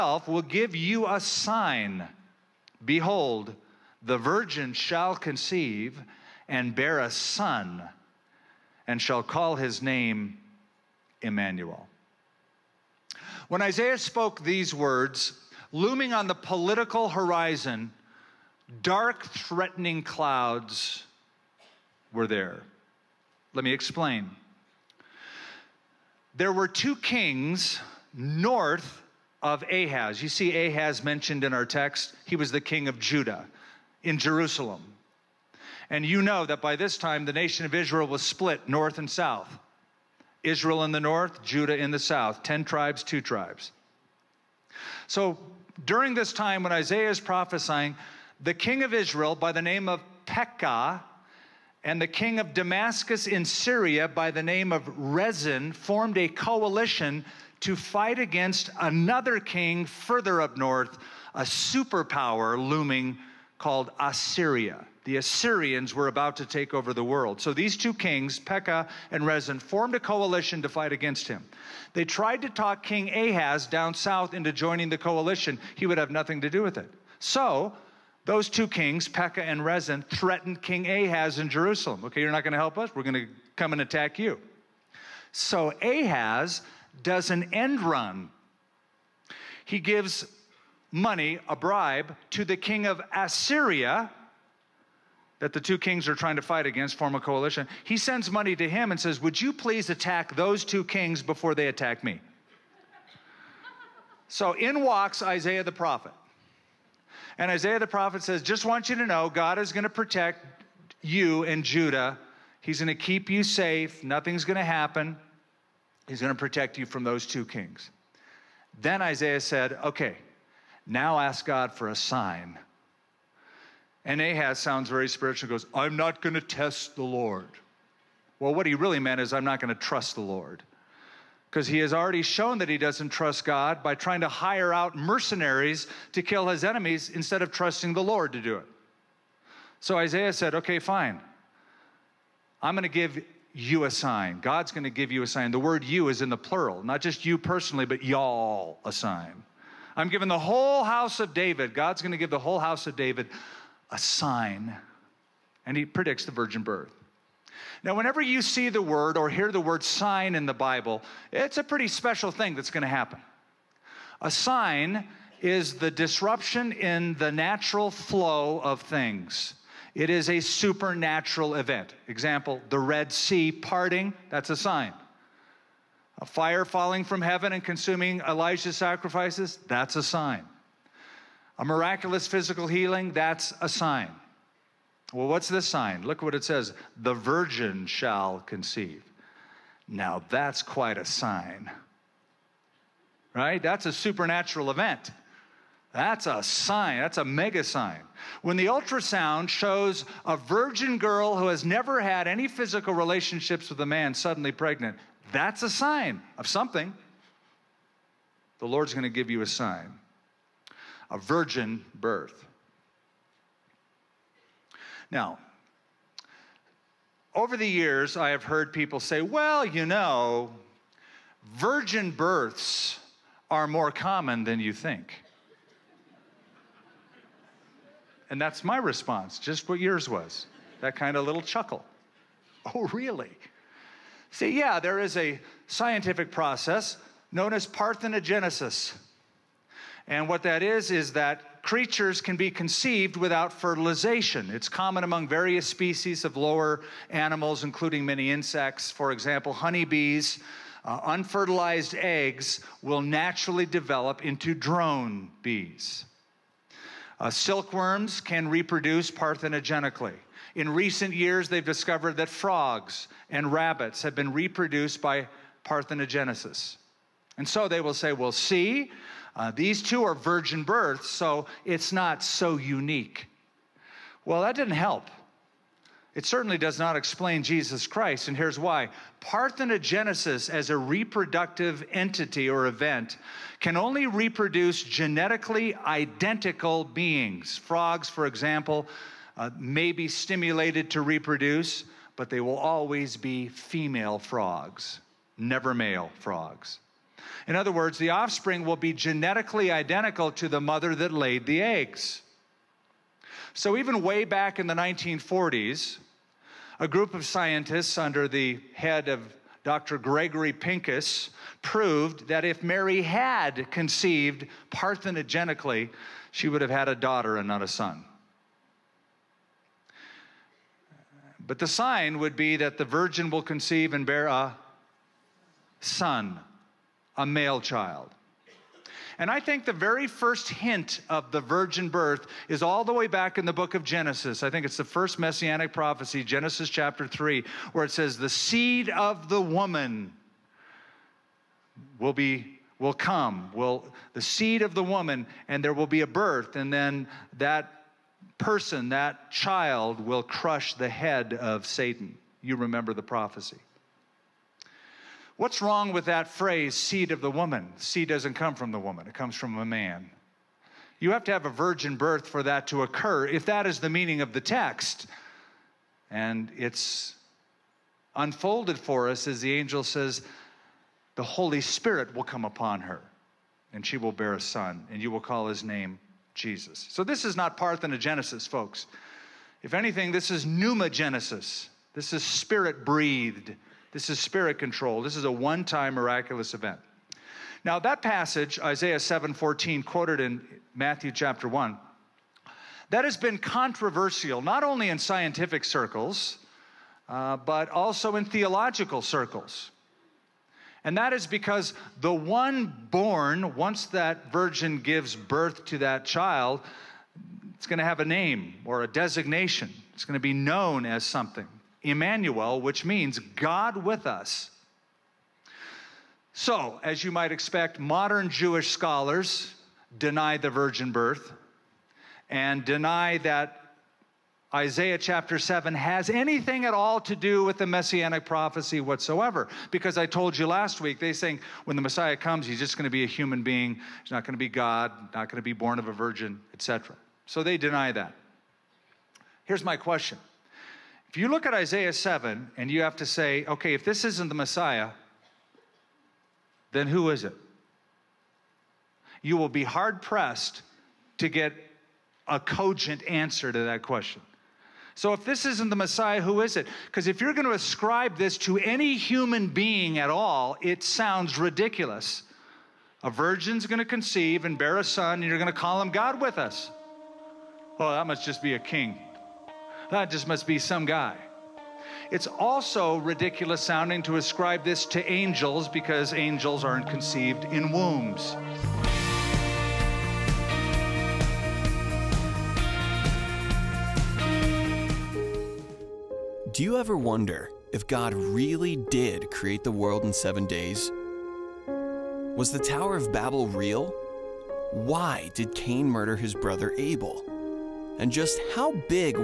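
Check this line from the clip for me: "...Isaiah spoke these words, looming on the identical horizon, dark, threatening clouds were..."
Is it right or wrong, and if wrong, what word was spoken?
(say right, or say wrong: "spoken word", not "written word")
wrong: "political", not "identical".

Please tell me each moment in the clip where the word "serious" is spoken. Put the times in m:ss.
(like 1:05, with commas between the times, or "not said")
not said.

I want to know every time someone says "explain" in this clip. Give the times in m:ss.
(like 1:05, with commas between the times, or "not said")
0:23, 4:36.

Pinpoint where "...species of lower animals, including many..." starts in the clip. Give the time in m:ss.
4:05.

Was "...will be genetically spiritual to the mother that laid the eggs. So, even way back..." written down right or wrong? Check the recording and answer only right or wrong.
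wrong.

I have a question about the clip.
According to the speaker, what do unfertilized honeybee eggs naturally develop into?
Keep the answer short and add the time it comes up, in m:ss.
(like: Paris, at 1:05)
drone bees, at 4:14.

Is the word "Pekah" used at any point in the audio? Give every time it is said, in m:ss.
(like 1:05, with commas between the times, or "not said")
0:50, 1:08, 1:19.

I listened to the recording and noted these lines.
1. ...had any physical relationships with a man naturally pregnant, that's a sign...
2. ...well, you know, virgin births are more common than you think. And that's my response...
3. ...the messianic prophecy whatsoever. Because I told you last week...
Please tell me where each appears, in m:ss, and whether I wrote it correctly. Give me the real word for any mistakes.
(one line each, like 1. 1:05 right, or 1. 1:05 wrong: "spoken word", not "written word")
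1. 3:21 wrong: "suddenly", not "naturally"
2. 3:39 right
3. 7:07 right.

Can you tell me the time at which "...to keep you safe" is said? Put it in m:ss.
1:52.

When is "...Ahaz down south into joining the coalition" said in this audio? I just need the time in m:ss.
1:13.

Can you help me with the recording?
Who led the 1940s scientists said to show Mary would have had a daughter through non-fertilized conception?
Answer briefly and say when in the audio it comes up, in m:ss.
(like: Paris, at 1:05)
Dr. Gregory Pincus, at 5:09.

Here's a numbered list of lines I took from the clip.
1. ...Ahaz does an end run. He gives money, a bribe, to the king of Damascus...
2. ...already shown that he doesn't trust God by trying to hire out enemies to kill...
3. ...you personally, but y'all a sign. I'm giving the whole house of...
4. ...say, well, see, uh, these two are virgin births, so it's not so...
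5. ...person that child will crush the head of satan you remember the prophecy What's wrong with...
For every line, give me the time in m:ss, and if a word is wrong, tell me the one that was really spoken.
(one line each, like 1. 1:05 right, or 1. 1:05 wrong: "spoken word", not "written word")
1. 1:25 wrong: "Assyria", not "Damascus"
2. 2:11 wrong: "mercenaries", not "enemies"
3. 2:27 right
4. 4:27 right
5. 5:48 right.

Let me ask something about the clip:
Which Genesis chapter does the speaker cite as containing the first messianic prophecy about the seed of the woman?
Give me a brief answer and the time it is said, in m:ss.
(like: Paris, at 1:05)
Chapter 3, at 5:36.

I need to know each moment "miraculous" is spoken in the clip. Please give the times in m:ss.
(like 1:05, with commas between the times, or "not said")
3:01, 6:25.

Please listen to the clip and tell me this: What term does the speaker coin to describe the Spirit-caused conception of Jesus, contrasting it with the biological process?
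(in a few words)
pneumogenesis.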